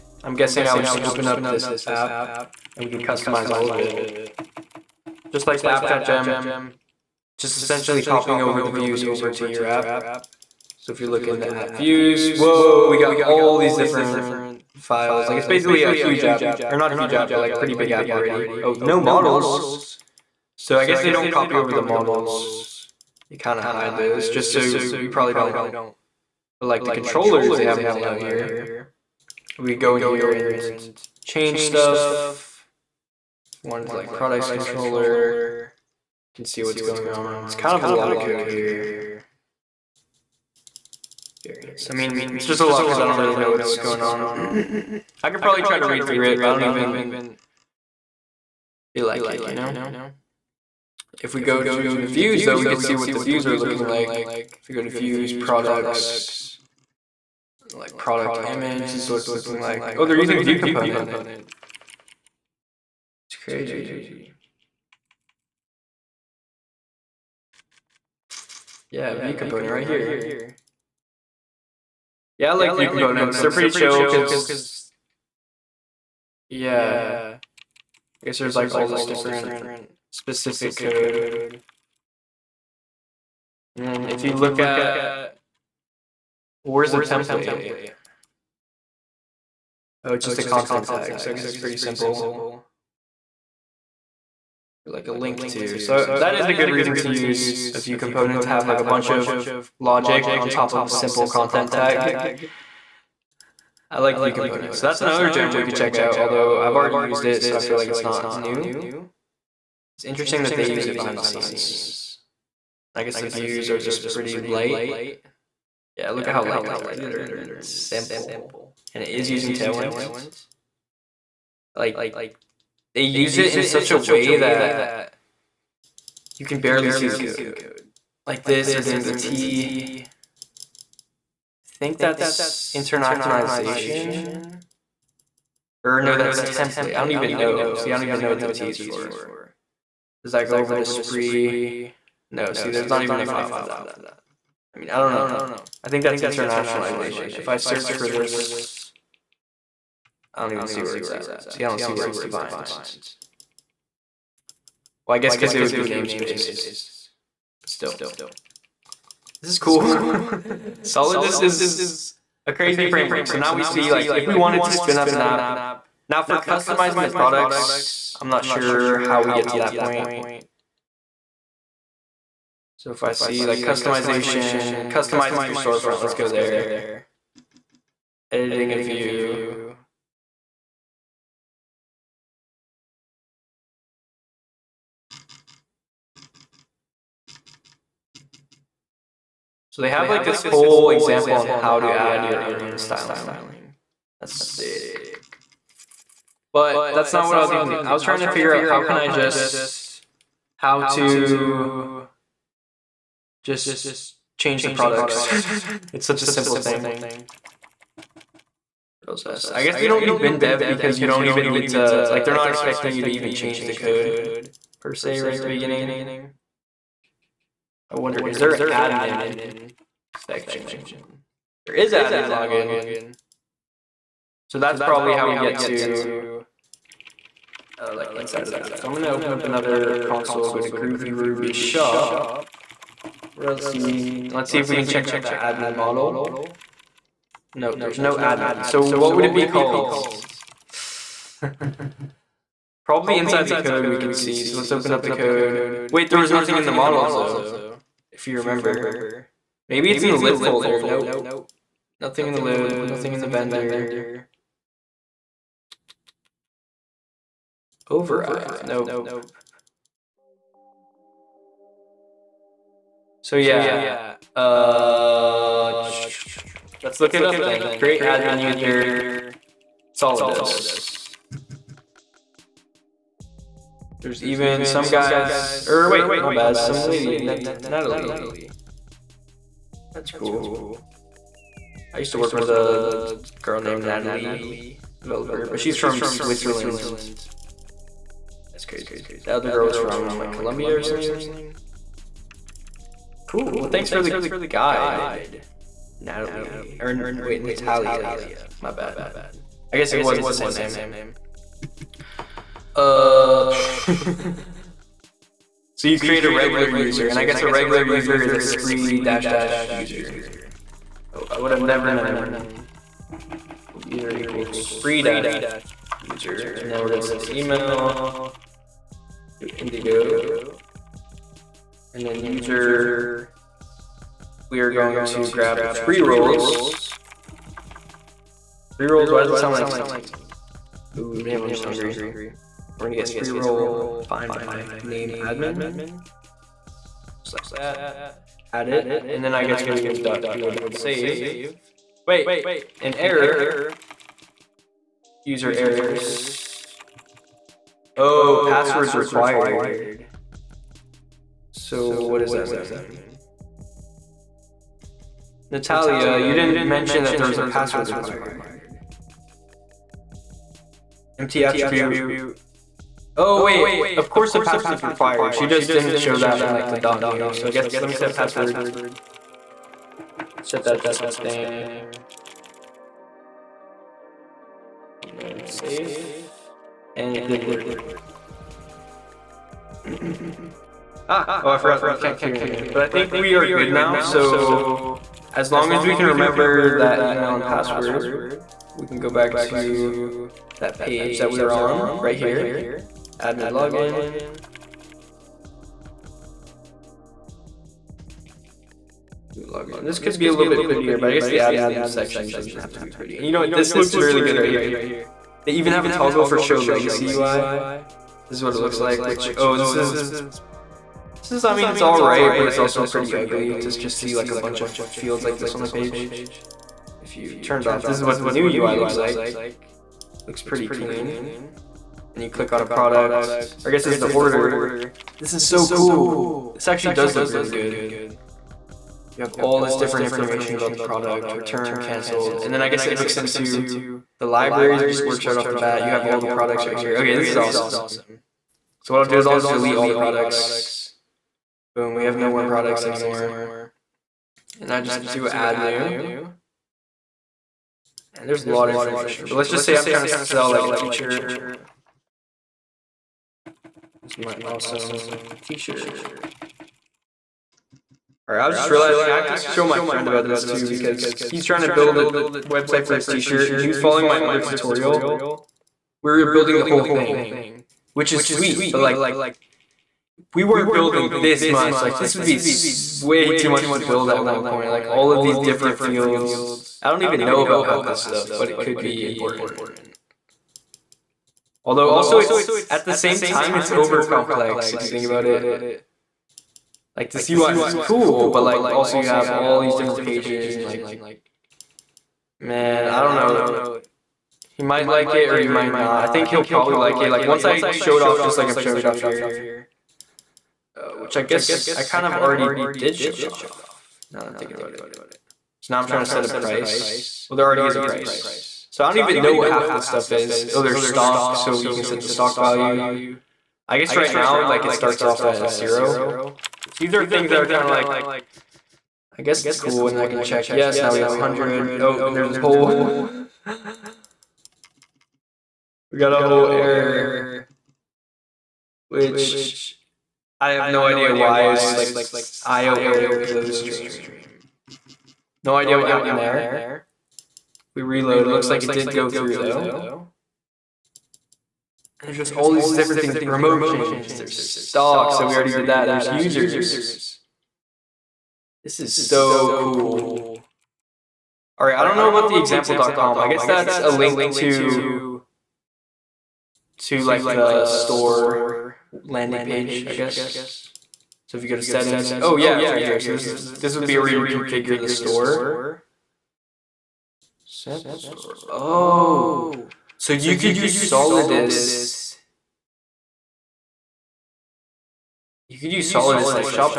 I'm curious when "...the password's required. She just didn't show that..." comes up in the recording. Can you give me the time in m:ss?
6:04.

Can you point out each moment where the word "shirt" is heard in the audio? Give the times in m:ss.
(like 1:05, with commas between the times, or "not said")
7:35, 7:43.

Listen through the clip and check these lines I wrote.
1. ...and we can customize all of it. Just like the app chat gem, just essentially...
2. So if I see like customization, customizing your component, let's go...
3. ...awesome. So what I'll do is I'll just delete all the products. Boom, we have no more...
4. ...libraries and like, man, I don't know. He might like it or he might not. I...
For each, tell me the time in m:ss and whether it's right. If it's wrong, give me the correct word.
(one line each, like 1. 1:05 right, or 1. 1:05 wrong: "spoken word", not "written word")
1. 0:02 right
2. 2:52 wrong: "storefront", not "component"
3. 7:17 right
4. 8:10 wrong: "pages", not "libraries".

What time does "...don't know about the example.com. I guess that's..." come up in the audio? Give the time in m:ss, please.
9:11.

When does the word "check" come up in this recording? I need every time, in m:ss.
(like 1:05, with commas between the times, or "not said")
1:45, 3:54, 8:40.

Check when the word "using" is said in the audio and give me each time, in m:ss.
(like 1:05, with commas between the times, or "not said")
1:00, 1:59.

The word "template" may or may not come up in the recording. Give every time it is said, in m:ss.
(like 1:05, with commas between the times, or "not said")
1:27, 2:16.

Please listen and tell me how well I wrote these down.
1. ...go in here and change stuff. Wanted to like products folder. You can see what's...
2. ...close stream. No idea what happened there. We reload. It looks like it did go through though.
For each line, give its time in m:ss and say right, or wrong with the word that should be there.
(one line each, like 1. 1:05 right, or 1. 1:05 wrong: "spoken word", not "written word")
1. 0:29 wrong: "controller", not "folder"
2. 8:53 right.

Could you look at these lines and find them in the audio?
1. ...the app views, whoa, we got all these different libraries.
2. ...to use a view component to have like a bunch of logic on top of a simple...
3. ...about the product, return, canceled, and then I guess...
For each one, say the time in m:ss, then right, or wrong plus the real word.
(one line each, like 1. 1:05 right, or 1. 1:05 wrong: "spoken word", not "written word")
1. 0:11 wrong: "files", not "libraries"
2. 1:36 right
3. 7:10 right.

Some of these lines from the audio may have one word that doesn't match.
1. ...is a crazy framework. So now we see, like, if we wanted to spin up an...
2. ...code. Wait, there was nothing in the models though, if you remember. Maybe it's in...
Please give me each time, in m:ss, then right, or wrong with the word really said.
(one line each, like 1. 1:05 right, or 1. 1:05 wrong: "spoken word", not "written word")
1. 2:41 right
2. 4:05 right.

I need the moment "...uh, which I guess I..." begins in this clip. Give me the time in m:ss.
8:20.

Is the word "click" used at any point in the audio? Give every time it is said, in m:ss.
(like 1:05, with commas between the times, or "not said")
7:02.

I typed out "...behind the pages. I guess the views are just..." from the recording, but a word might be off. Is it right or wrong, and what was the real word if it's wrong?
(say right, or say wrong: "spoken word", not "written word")
wrong: "scenes", not "pages".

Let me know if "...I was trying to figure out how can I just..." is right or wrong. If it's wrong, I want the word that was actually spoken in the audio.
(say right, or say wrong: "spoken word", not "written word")
right.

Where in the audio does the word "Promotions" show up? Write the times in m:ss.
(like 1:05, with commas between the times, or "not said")
9:03.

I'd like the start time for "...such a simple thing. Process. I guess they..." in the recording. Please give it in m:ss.
3:26.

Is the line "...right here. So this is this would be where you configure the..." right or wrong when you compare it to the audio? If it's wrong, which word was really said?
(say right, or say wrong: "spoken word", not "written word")
right.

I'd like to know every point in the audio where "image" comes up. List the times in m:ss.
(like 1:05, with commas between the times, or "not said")
0:58.